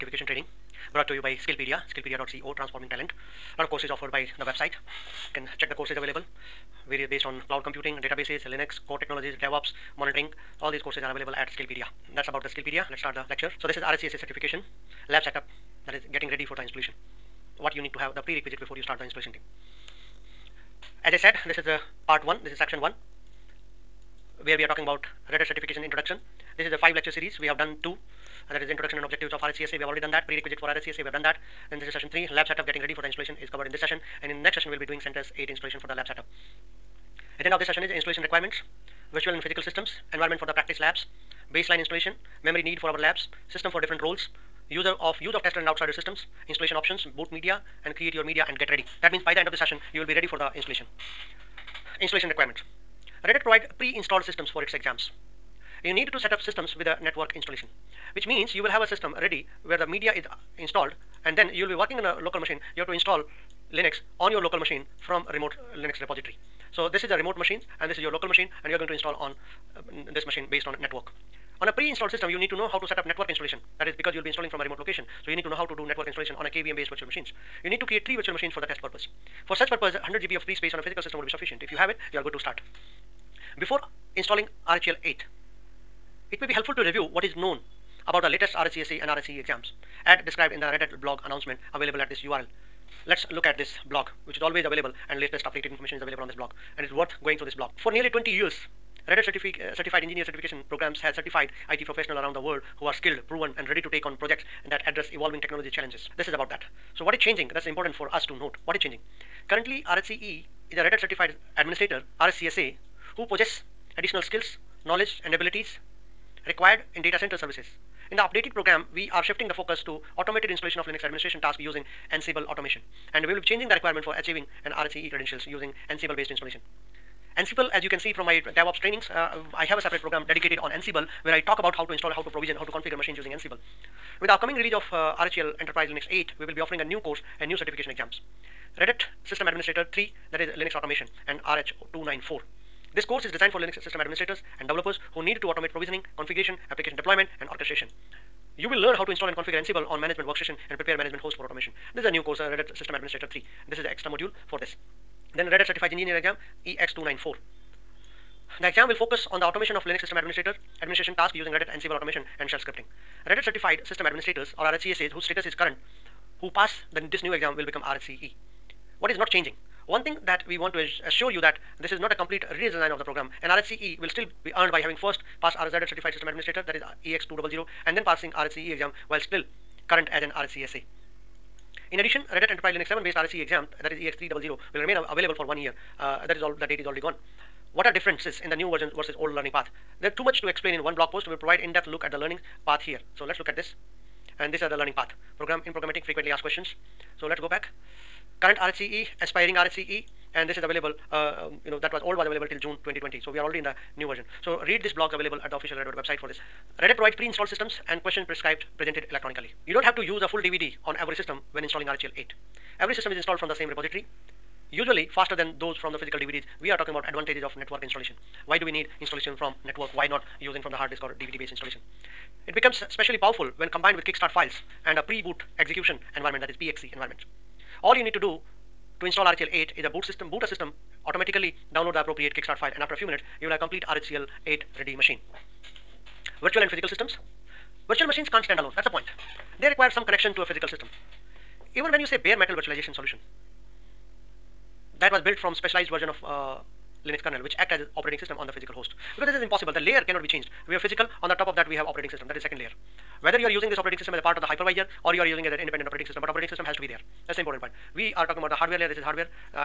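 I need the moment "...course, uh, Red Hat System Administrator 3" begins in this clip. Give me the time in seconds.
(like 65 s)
152 s.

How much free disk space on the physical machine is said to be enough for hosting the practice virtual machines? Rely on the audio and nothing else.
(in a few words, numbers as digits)
100 GB.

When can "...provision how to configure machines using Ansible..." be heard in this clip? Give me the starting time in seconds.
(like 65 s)
132 s.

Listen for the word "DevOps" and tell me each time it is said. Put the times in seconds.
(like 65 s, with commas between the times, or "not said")
9 s, 128 s.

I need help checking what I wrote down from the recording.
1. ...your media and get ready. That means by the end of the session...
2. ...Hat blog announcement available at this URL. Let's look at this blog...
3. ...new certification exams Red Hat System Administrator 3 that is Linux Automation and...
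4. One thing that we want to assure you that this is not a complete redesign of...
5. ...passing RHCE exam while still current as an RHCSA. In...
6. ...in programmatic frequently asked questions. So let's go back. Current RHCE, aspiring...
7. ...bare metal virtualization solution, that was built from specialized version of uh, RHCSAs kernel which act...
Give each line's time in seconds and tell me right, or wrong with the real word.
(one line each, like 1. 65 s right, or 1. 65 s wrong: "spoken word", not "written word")
1. 48 s right
2. 90 s right
3. 137 s right
4. 169 s right
5. 178 s right
6. 195 s right
7. 242 s wrong: "Linux", not "RHCSAs".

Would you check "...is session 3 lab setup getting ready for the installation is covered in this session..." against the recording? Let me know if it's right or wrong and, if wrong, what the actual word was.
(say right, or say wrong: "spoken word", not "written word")
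right.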